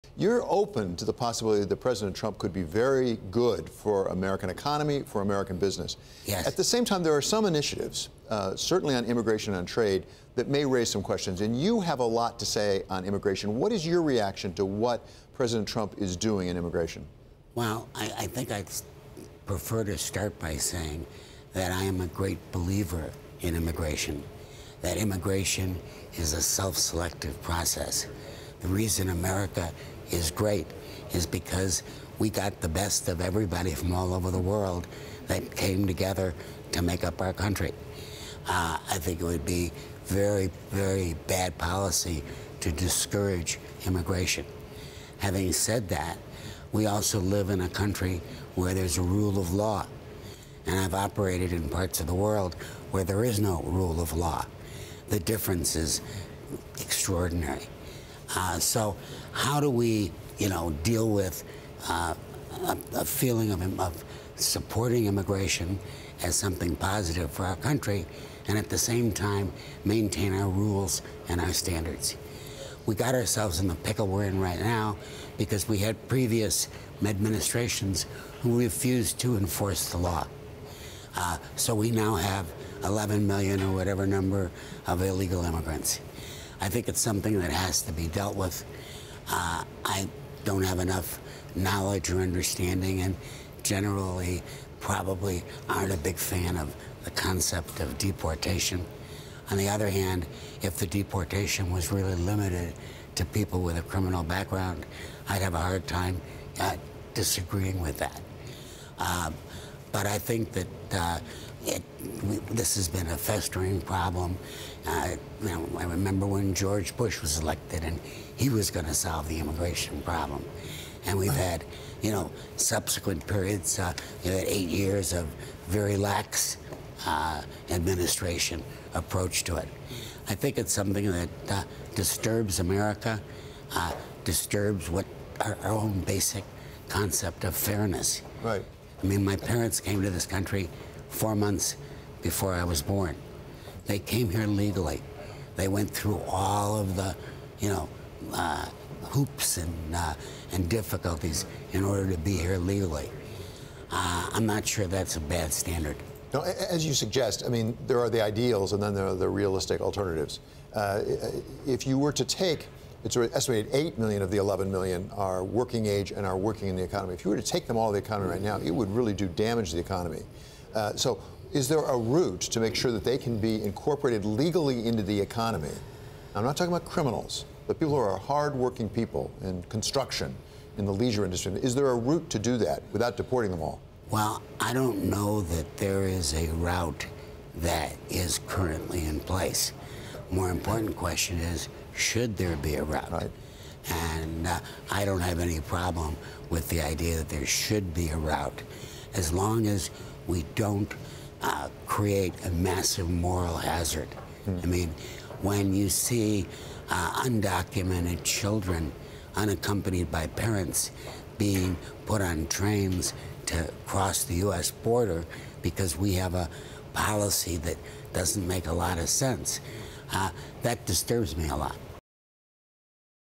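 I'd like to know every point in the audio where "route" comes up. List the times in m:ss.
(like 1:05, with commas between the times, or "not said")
2:51, 3:01, 3:06, 3:12, 3:18.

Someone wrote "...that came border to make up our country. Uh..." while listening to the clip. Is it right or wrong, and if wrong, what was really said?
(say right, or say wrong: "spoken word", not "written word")
wrong: "together", not "border".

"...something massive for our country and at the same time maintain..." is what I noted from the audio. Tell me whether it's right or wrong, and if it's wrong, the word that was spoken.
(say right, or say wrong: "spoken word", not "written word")
wrong: "positive", not "massive".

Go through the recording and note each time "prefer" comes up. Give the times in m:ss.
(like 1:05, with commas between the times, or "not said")
0:19.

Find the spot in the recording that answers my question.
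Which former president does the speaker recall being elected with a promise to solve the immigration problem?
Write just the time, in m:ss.
1:56.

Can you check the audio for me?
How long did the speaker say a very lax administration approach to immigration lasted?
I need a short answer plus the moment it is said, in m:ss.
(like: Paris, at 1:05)
8 years, at 2:04.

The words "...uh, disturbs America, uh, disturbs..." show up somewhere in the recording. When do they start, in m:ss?
2:11.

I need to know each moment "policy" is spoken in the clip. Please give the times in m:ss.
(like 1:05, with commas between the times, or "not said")
0:41, 3:36.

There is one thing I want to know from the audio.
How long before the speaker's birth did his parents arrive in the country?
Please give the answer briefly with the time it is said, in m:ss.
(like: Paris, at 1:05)
4 months, at 2:21.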